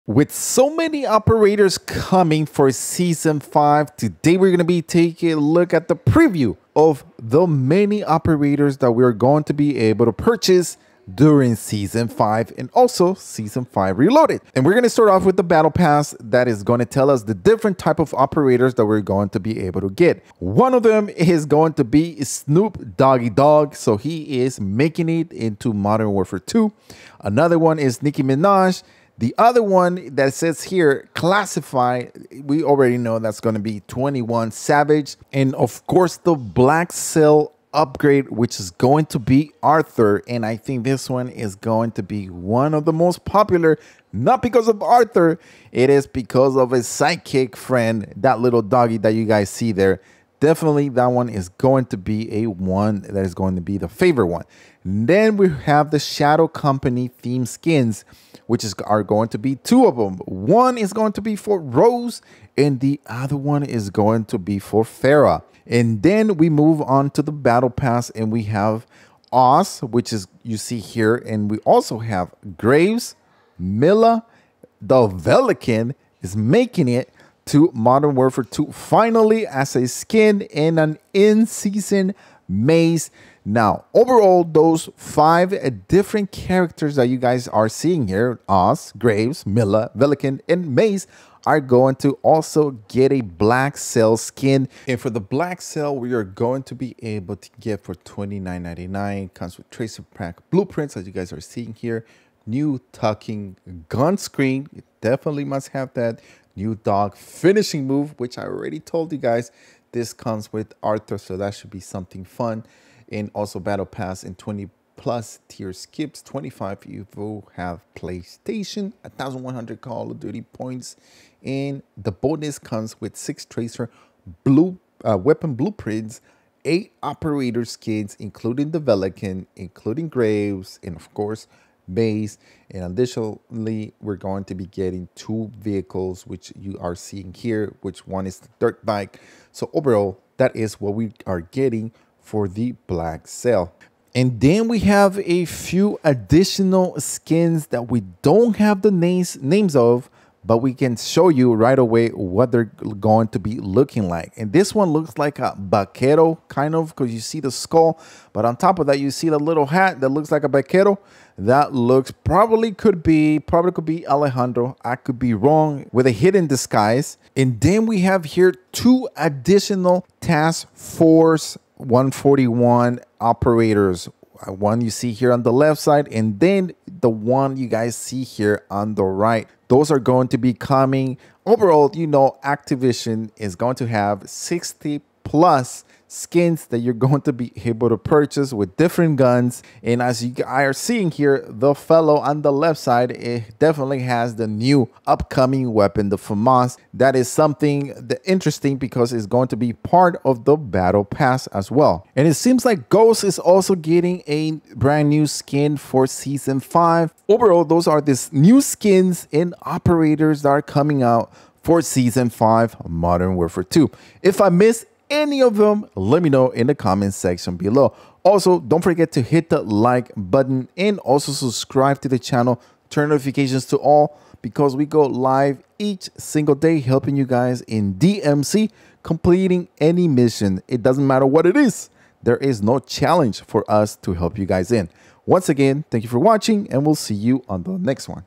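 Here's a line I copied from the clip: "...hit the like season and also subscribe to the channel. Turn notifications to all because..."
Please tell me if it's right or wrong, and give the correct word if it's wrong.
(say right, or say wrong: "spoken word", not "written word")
wrong: "button", not "season".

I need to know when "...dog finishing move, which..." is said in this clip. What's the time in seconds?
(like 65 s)
106 s.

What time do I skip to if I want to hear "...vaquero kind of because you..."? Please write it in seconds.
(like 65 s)
155 s.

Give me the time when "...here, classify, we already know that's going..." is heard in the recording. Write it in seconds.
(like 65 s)
30 s.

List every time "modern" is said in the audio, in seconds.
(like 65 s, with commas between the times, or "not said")
25 s, 77 s, 212 s.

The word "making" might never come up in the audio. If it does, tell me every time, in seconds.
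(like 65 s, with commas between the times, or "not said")
24 s, 76 s.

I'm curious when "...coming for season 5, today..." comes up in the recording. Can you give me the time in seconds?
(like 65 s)
1 s.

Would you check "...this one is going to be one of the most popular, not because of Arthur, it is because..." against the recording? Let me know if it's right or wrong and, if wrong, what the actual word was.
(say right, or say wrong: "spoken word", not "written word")
right.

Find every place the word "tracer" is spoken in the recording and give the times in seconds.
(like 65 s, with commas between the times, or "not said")
99 s, 123 s.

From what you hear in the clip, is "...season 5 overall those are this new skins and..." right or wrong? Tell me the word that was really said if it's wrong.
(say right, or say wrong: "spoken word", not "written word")
right.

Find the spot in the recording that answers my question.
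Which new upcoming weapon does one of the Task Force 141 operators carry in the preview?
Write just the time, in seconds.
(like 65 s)
196 s.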